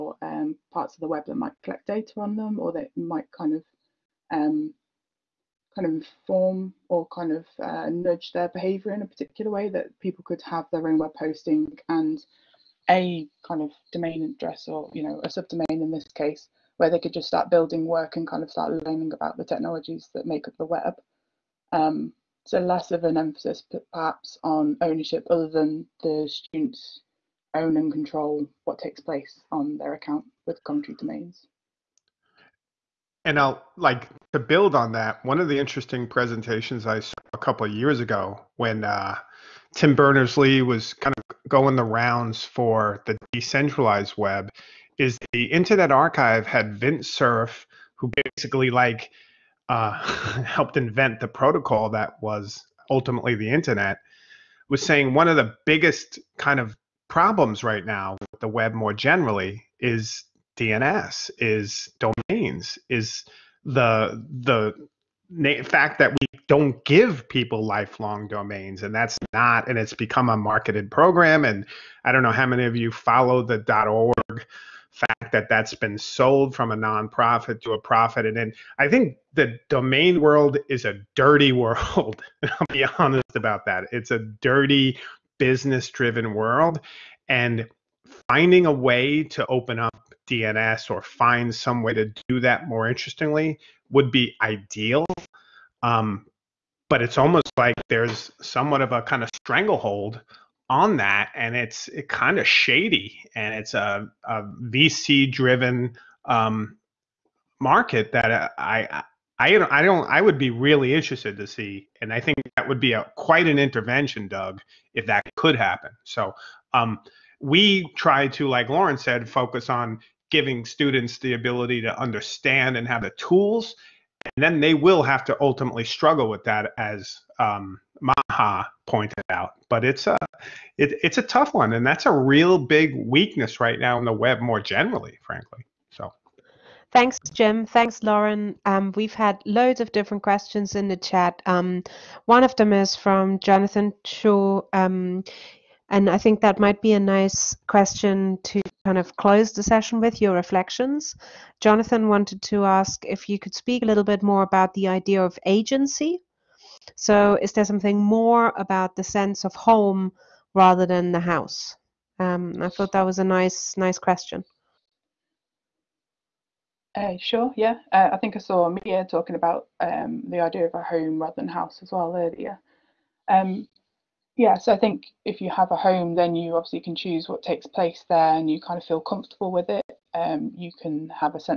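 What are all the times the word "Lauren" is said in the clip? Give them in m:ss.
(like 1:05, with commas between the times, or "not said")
1:58, 2:18.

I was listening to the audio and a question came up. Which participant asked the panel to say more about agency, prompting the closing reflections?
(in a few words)
Jonathan Shaw.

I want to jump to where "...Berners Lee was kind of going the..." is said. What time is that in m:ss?
0:39.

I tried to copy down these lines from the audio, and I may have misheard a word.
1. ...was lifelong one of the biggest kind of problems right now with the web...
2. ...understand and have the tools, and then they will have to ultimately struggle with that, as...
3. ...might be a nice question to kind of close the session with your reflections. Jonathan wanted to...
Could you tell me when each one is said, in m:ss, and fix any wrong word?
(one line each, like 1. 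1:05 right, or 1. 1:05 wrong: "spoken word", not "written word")
1. 0:54 wrong: "saying", not "lifelong"
2. 2:01 right
3. 2:26 right.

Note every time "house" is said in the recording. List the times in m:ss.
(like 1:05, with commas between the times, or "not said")
2:41, 2:51.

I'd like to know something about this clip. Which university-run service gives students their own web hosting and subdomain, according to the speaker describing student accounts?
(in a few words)
Coventry domains.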